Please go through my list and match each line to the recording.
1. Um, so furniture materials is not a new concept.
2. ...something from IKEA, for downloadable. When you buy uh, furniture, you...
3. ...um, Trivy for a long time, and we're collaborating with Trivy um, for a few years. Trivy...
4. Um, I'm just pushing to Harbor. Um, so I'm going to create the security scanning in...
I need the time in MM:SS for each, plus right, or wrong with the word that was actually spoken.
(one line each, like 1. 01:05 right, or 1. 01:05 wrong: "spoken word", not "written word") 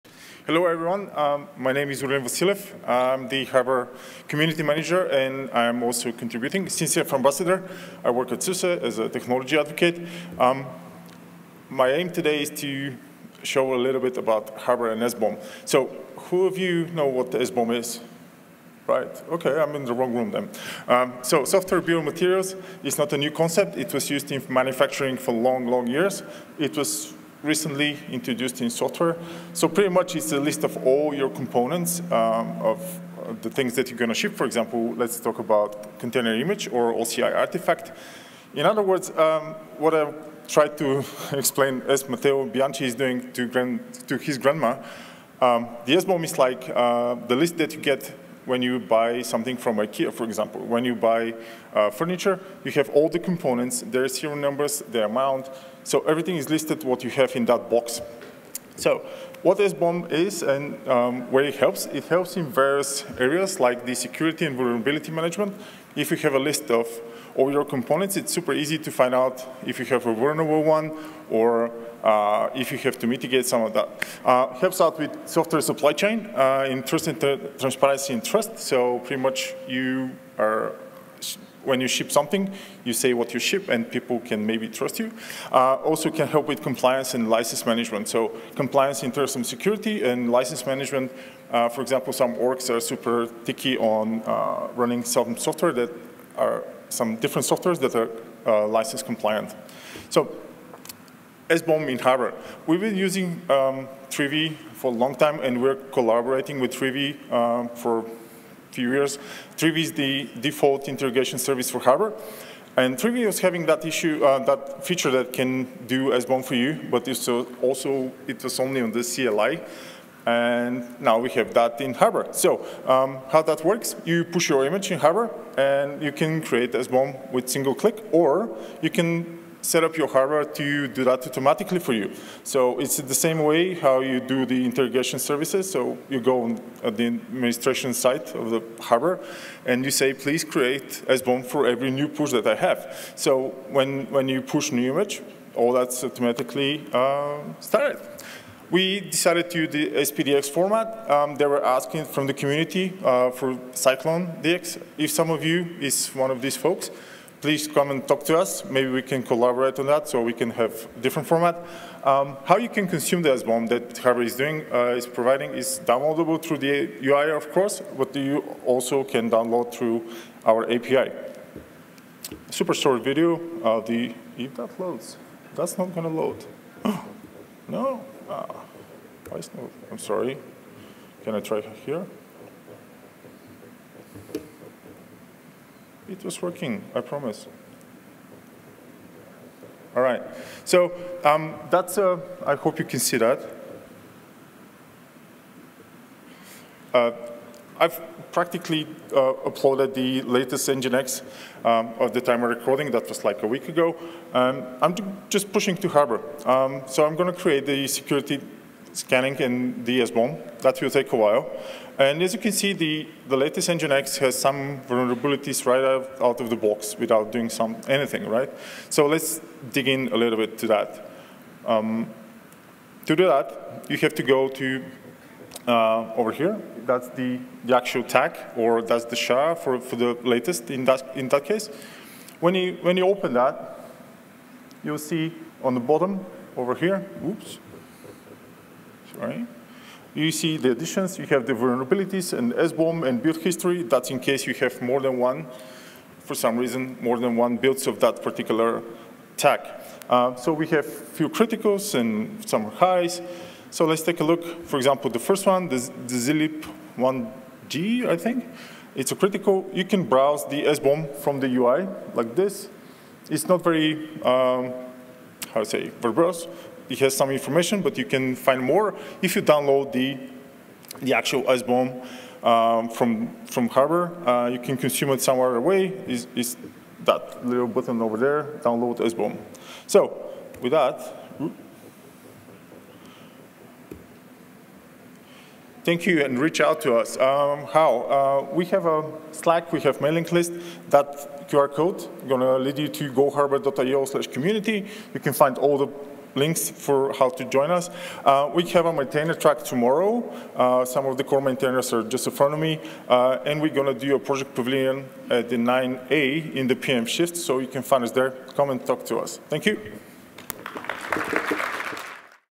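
1. 00:20 wrong: "software", not "furniture"
2. 00:49 wrong: "example", not "downloadable"
3. 01:43 right
4. 03:24 right.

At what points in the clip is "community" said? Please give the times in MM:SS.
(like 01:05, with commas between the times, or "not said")
00:04, 02:32, 04:54.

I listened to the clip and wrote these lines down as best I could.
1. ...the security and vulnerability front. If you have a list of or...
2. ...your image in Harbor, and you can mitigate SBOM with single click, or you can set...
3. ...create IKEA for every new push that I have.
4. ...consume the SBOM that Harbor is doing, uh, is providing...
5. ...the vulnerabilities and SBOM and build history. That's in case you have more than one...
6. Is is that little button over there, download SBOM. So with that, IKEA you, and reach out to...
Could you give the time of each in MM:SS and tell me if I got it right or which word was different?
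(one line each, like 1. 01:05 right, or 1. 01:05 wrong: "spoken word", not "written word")
1. 01:03 wrong: "management", not "front"
2. 02:04 wrong: "create", not "mitigate"
3. 02:20 wrong: "SBOM", not "IKEA"
4. 02:42 right
5. 04:01 right
6. 04:36 wrong: "Thank", not "IKEA".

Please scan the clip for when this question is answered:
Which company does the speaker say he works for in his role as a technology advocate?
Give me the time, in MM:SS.
00:08.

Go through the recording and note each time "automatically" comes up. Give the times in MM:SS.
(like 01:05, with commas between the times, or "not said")
02:11, 02:26.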